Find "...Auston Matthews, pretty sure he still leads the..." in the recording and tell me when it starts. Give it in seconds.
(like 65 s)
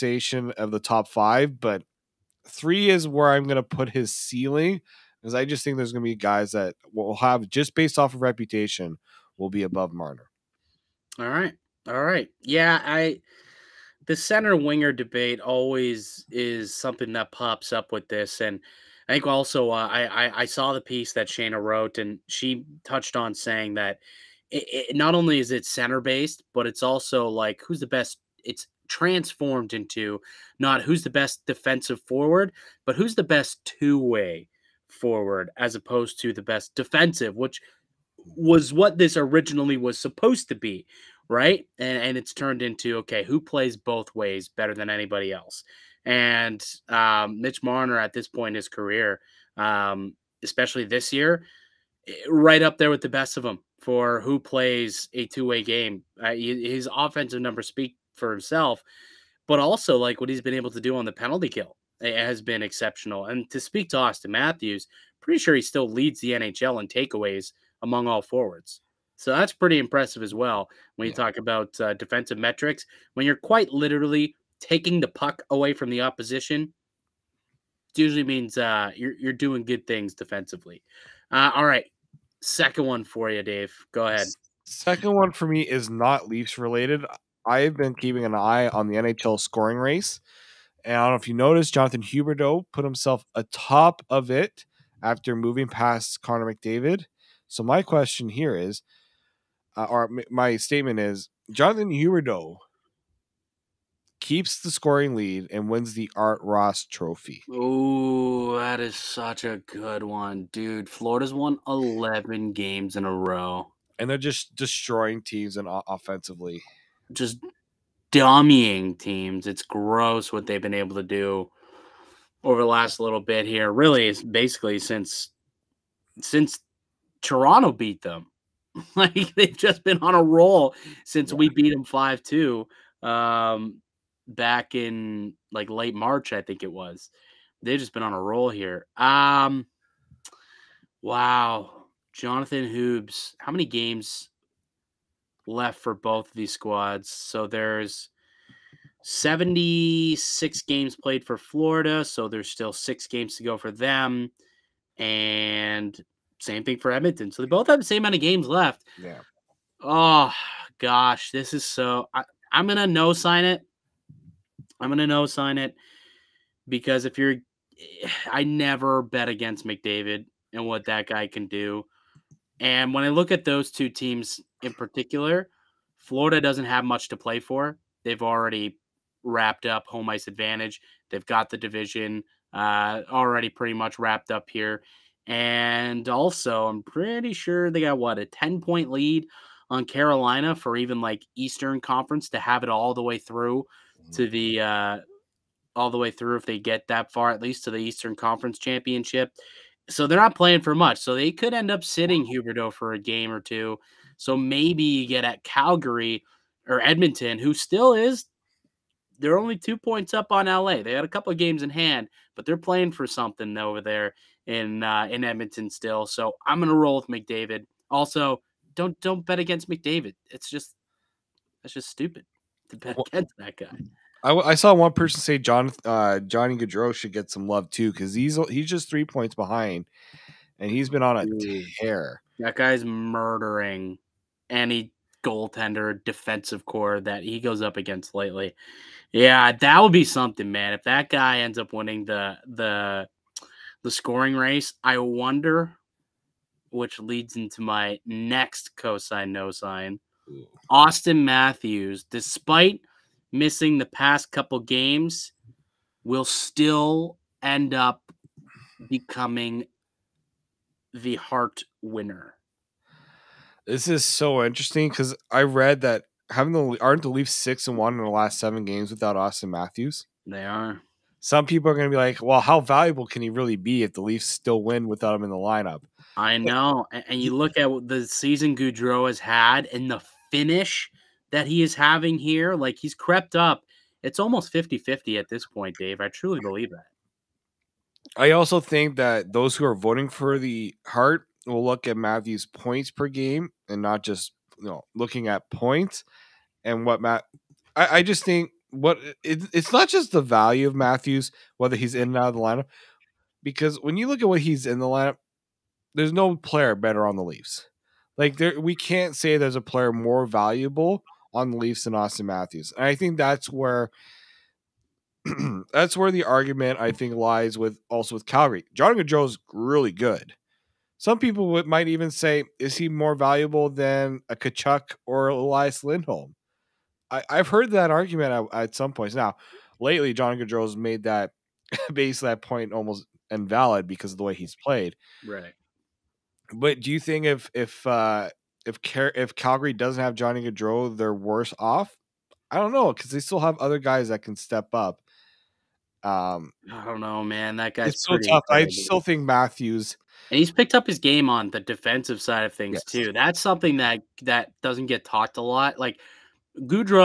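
63 s.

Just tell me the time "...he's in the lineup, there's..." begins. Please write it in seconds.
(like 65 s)
304 s.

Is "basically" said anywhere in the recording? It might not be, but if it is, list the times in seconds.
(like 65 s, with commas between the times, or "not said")
124 s, 331 s.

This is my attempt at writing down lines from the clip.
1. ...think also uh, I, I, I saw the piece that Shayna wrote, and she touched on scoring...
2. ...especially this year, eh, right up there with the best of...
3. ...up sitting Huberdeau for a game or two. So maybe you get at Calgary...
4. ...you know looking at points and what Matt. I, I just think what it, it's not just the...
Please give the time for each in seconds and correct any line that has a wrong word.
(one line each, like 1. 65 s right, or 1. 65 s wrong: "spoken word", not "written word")
1. 19 s wrong: "saying", not "scoring"
2. 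50 s right
3. 201 s right
4. 294 s right.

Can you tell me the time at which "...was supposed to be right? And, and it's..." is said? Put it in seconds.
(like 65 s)
39 s.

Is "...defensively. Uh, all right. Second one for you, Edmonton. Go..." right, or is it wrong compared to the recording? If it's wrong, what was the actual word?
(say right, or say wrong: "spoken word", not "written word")
wrong: "Dave", not "Edmonton".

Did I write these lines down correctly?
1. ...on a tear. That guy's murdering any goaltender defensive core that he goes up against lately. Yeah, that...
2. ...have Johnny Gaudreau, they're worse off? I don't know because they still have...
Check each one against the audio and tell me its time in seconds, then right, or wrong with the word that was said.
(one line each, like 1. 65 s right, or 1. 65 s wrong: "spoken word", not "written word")
1. 231 s right
2. 340 s right.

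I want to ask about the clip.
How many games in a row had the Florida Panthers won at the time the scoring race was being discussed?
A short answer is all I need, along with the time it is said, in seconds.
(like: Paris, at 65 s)
11, at 111 s.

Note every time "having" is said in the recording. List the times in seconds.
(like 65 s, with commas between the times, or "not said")
266 s, 281 s.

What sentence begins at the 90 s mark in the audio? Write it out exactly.
And I don't know if you noticed, Jonathan Huberdeau put himself atop of it after moving past Connor McDavid.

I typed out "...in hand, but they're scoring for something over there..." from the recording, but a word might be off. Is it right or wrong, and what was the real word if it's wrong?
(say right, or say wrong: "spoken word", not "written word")
wrong: "playing", not "scoring".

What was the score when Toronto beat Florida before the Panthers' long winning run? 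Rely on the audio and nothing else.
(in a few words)
5-2.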